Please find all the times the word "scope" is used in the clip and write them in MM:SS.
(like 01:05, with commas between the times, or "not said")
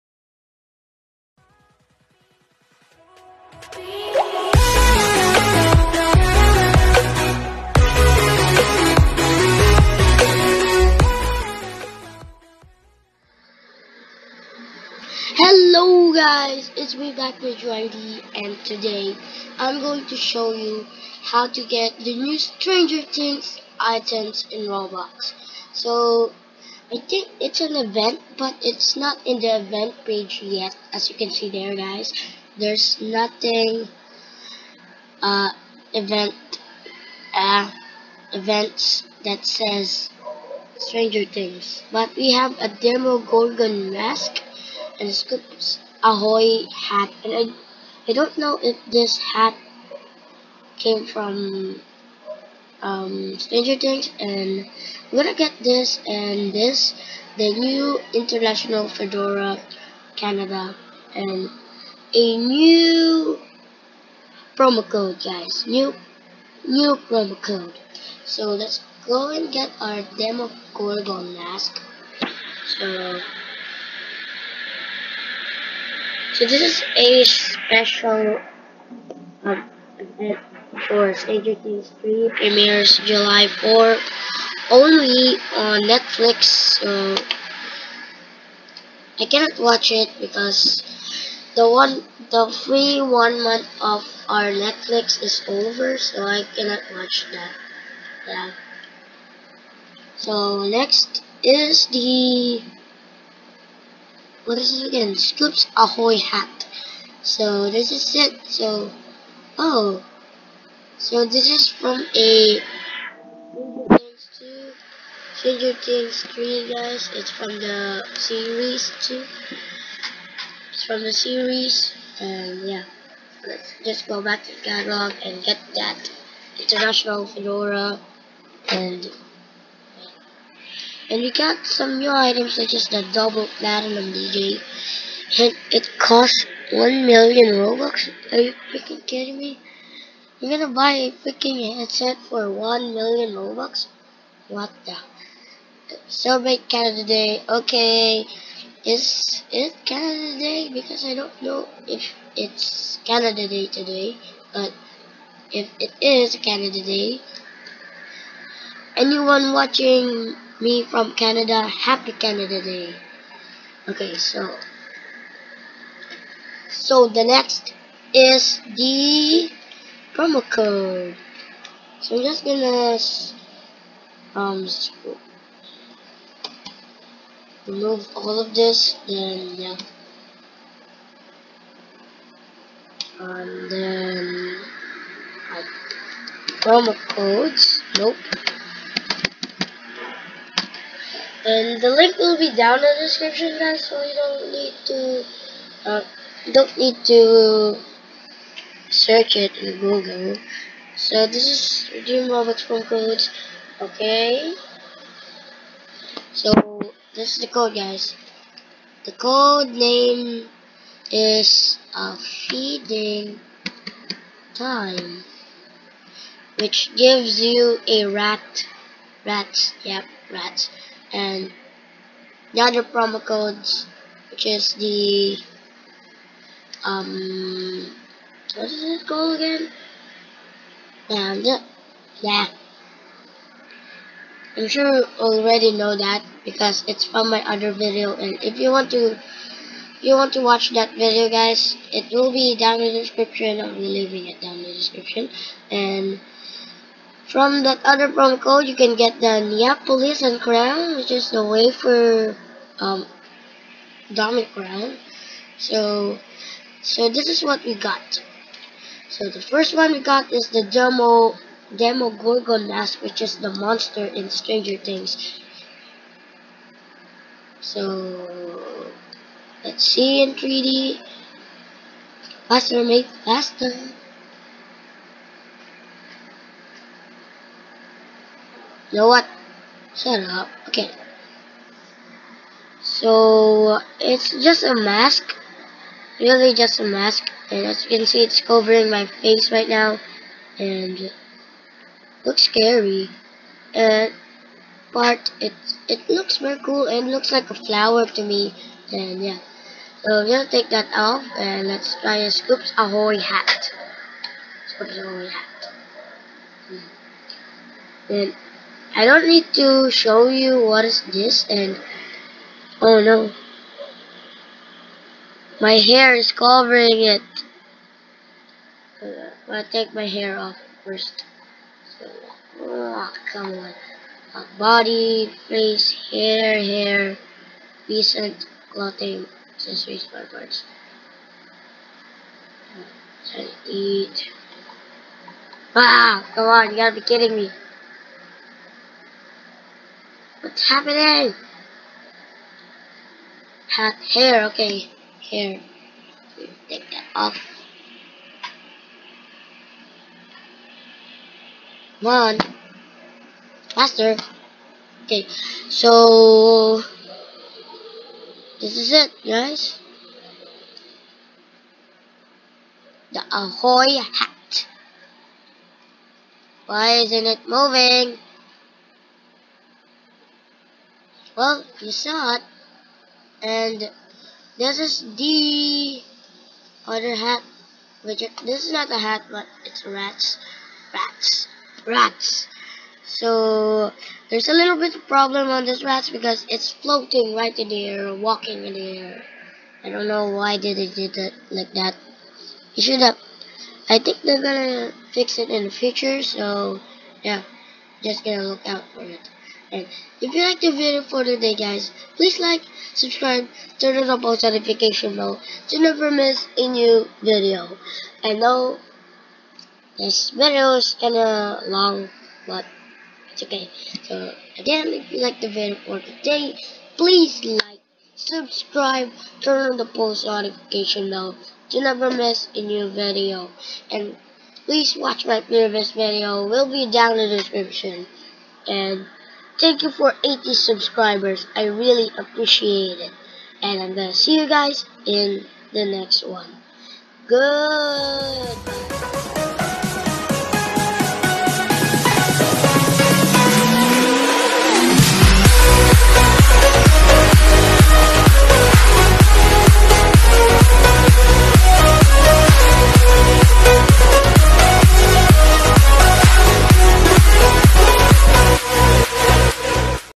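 not said.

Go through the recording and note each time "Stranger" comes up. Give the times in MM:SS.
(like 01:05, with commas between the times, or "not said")
00:22, 00:40, 00:53, 01:21, 01:55, 04:24.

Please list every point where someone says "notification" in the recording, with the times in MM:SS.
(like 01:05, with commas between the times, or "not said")
06:44, 07:00.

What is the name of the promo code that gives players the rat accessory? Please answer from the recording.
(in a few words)
Feeding Time.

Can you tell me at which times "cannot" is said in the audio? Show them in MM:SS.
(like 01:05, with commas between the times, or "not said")
01:29, 01:36.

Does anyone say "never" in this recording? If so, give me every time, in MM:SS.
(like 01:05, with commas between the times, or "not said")
06:45, 07:01.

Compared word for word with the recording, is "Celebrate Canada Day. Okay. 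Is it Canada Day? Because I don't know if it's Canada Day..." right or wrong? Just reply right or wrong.
right.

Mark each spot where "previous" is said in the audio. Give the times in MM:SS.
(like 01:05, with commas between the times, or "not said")
07:05.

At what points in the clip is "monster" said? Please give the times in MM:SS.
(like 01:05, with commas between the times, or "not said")
04:23.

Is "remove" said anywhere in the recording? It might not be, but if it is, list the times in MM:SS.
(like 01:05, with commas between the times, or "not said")
02:57.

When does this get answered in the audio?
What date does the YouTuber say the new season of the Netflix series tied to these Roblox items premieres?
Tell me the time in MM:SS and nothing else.
01:23.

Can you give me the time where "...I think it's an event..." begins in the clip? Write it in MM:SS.
00:26.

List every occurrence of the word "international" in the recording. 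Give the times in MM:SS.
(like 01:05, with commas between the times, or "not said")
00:58, 02:06.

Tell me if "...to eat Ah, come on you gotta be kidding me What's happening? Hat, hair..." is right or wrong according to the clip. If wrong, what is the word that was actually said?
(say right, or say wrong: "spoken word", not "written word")
right.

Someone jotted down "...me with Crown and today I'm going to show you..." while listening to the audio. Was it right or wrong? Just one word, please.
wrong.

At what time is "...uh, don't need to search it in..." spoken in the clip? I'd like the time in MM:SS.
03:15.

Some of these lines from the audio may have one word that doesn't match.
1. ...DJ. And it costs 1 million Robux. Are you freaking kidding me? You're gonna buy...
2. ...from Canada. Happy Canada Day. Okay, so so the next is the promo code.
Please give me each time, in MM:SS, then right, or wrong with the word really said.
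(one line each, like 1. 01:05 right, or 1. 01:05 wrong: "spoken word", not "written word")
1. 02:14 right
2. 02:40 right.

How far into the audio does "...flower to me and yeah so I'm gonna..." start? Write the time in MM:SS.
04:57.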